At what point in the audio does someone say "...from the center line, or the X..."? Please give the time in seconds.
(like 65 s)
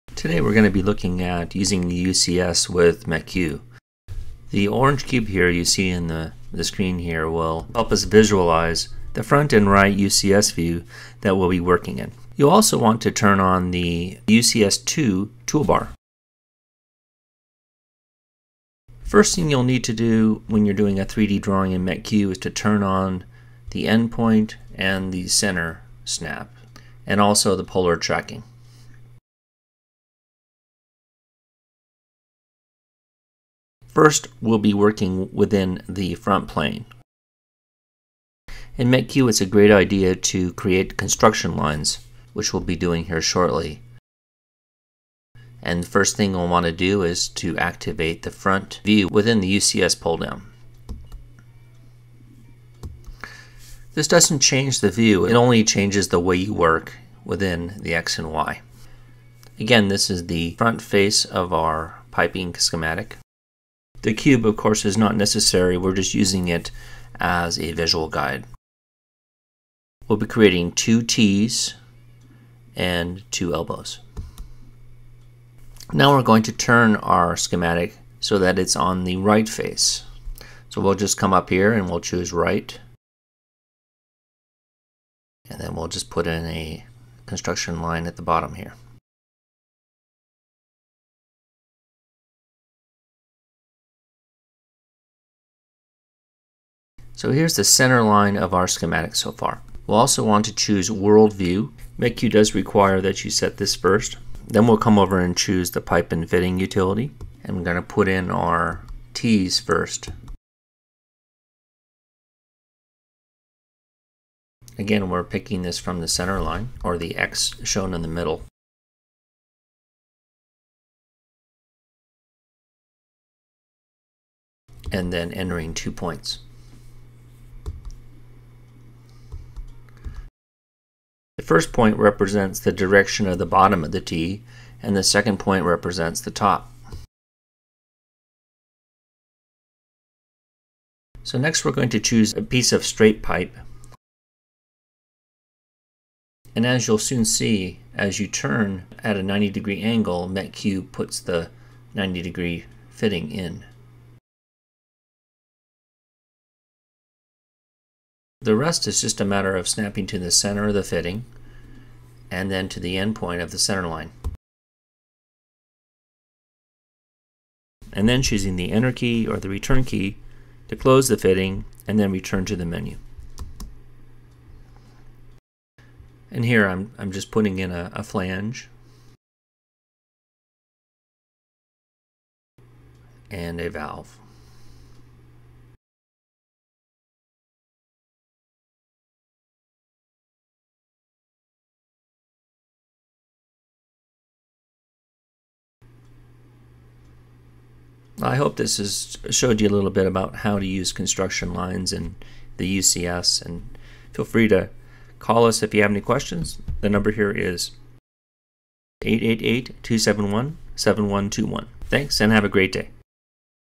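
115 s.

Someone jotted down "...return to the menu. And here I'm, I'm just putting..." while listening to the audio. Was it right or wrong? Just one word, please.
right.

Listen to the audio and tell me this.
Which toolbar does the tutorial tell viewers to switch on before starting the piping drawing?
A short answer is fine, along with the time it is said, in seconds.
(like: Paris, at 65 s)
UCS2 toolbar, at 14 s.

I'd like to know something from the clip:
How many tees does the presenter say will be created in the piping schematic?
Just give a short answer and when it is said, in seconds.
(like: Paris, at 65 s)
2, at 70 s.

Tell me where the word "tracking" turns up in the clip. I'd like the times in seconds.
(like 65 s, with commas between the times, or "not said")
27 s.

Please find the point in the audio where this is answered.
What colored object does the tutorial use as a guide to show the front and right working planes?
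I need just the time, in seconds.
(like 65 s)
4 s.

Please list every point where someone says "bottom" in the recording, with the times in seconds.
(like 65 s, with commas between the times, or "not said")
88 s, 133 s.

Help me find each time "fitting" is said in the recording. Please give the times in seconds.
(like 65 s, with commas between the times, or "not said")
106 s, 152 s, 160 s, 171 s.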